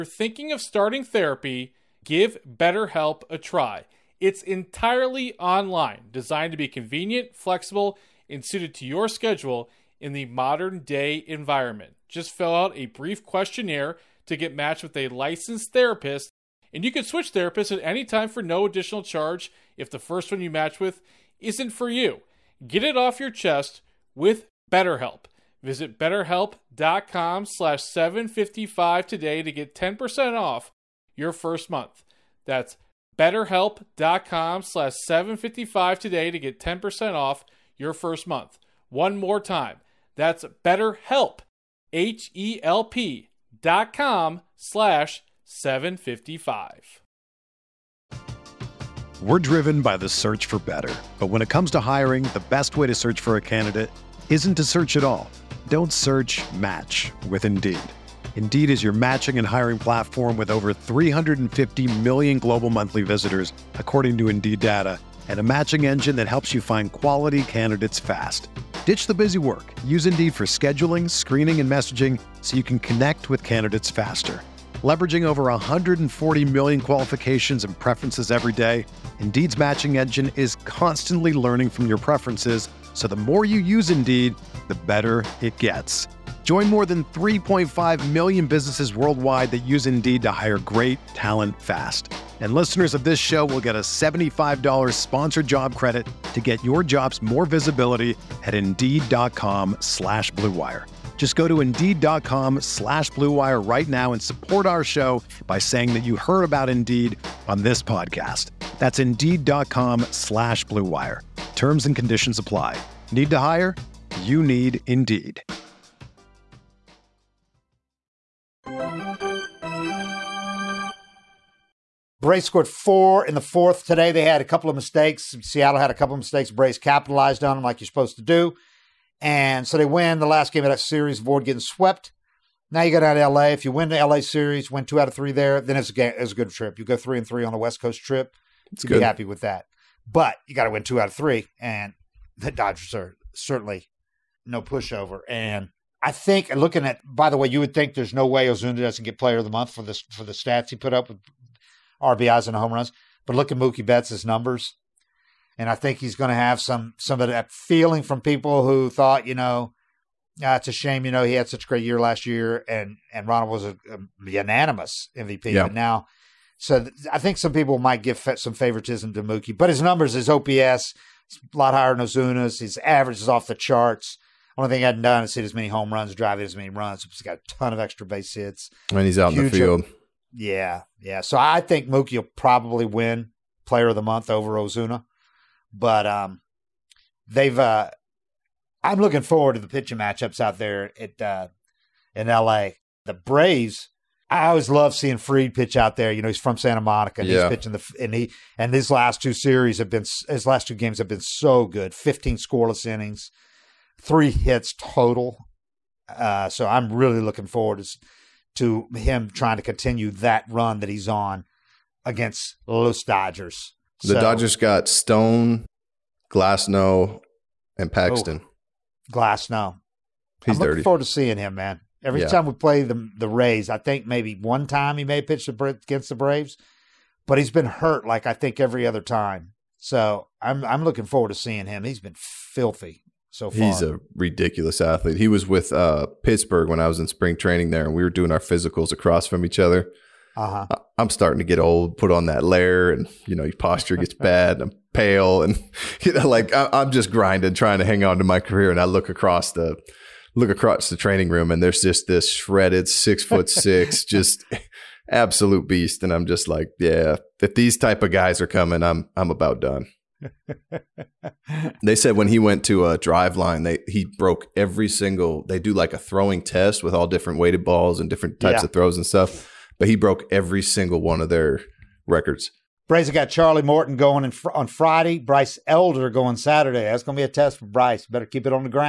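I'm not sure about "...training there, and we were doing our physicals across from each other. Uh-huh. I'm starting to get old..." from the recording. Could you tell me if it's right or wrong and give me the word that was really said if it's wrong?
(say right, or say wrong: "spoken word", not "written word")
right.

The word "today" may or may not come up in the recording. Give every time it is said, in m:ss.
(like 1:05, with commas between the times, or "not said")
0:29, 0:35, 2:03.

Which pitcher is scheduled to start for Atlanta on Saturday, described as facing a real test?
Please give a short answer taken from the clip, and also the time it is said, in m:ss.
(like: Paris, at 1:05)
Bryce Elder, at 4:35.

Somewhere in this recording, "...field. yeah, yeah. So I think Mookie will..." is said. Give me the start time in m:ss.
2:59.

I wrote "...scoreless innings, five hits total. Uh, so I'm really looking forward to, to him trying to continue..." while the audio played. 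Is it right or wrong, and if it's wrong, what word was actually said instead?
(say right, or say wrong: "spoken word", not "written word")
wrong: "three", not "five".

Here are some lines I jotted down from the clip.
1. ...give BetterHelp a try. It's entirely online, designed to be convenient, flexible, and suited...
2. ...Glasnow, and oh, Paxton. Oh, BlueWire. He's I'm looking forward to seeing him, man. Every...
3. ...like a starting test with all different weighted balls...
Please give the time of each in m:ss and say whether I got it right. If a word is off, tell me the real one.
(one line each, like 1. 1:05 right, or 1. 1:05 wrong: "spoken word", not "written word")
1. 0:02 right
2. 3:36 wrong: "Glasnow", not "BlueWire"
3. 4:25 wrong: "throwing", not "starting".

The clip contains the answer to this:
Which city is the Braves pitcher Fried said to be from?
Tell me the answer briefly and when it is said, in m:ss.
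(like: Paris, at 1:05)
Santa Monica, at 3:16.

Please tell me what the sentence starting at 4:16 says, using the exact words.
And I'm just like, yeah, if these type of guys are coming, I'm I'm about done.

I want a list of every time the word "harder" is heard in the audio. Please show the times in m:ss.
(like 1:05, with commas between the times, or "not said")
not said.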